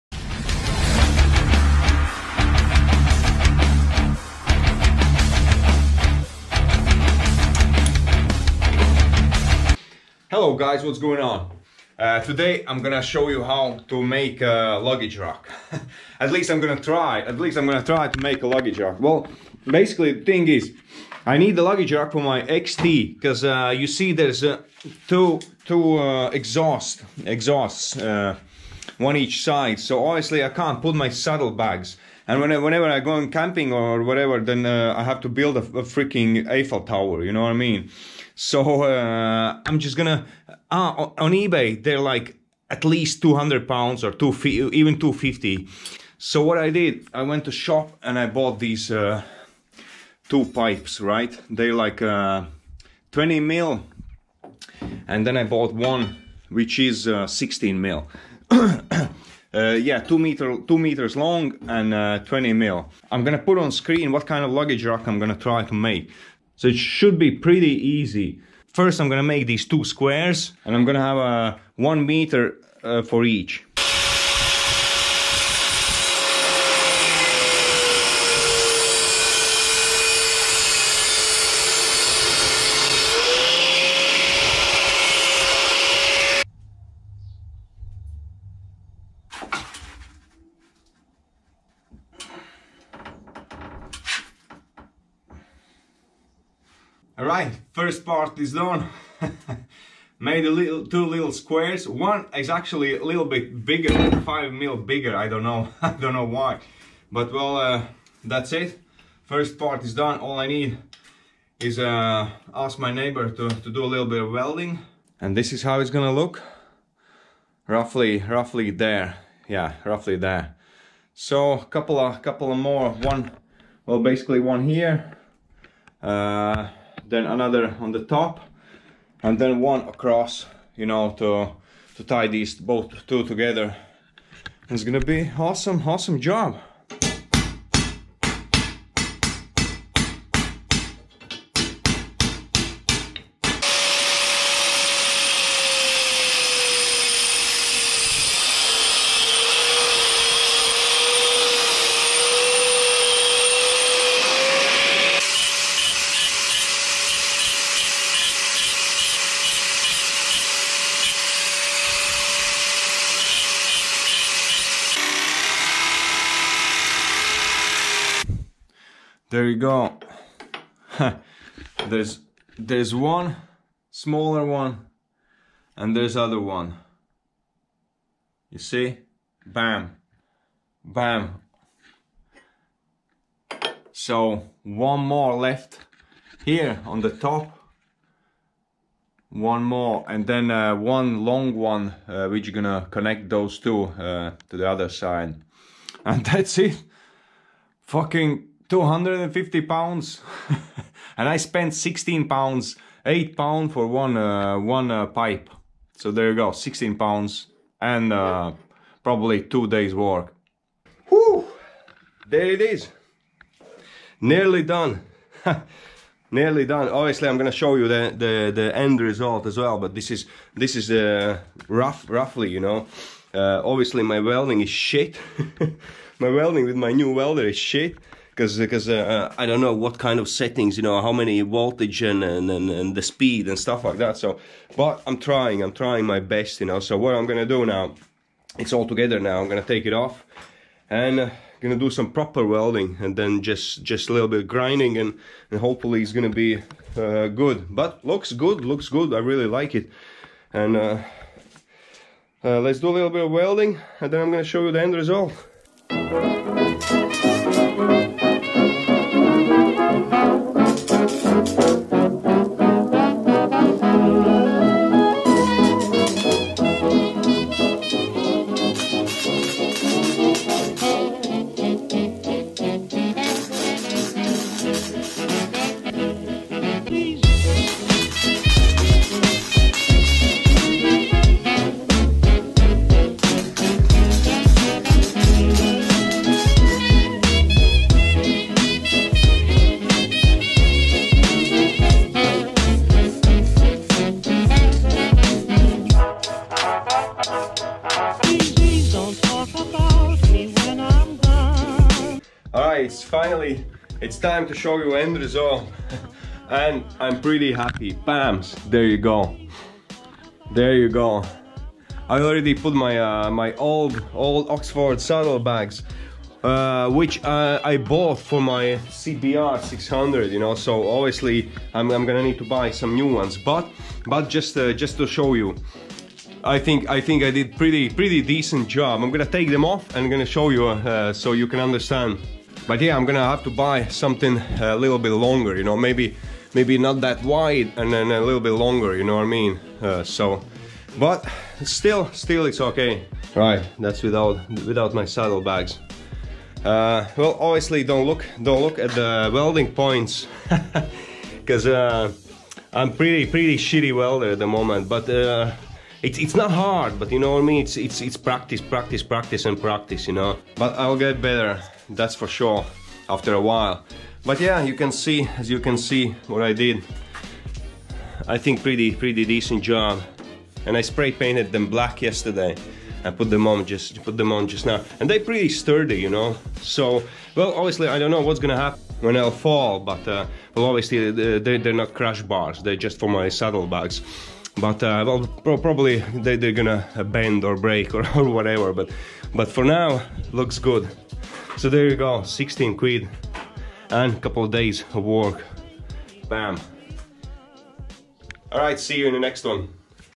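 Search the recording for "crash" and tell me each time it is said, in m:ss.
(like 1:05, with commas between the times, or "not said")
6:21.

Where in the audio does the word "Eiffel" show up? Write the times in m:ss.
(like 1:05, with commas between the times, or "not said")
0:36.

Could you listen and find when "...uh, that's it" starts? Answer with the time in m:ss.
1:47.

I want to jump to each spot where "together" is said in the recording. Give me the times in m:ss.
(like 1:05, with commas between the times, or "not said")
2:13, 3:58.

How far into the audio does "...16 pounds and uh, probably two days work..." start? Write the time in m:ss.
3:26.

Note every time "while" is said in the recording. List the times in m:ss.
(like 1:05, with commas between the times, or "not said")
6:03.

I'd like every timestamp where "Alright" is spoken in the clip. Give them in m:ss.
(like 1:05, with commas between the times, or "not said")
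1:37.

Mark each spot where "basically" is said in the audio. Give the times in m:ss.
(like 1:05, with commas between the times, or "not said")
0:19, 2:03.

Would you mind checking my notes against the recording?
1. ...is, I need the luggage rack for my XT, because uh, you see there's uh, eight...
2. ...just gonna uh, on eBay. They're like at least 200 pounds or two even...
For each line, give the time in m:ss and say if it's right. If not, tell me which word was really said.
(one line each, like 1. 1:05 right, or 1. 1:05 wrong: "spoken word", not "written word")
1. 0:20 wrong: "two", not "eight"
2. 0:39 right.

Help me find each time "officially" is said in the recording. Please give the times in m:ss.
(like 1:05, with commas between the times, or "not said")
not said.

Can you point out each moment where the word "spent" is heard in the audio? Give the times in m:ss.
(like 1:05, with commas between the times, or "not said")
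3:21.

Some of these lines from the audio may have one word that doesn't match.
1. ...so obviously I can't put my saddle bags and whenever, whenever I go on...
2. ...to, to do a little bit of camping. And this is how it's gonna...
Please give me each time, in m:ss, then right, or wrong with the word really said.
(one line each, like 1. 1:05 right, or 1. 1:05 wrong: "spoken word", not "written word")
1. 0:29 right
2. 1:53 wrong: "welding", not "camping".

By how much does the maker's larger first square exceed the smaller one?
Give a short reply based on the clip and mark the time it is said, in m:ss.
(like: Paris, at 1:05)
5 mm, at 1:44.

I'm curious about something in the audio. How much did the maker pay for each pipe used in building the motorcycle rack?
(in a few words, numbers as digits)
8 pounds.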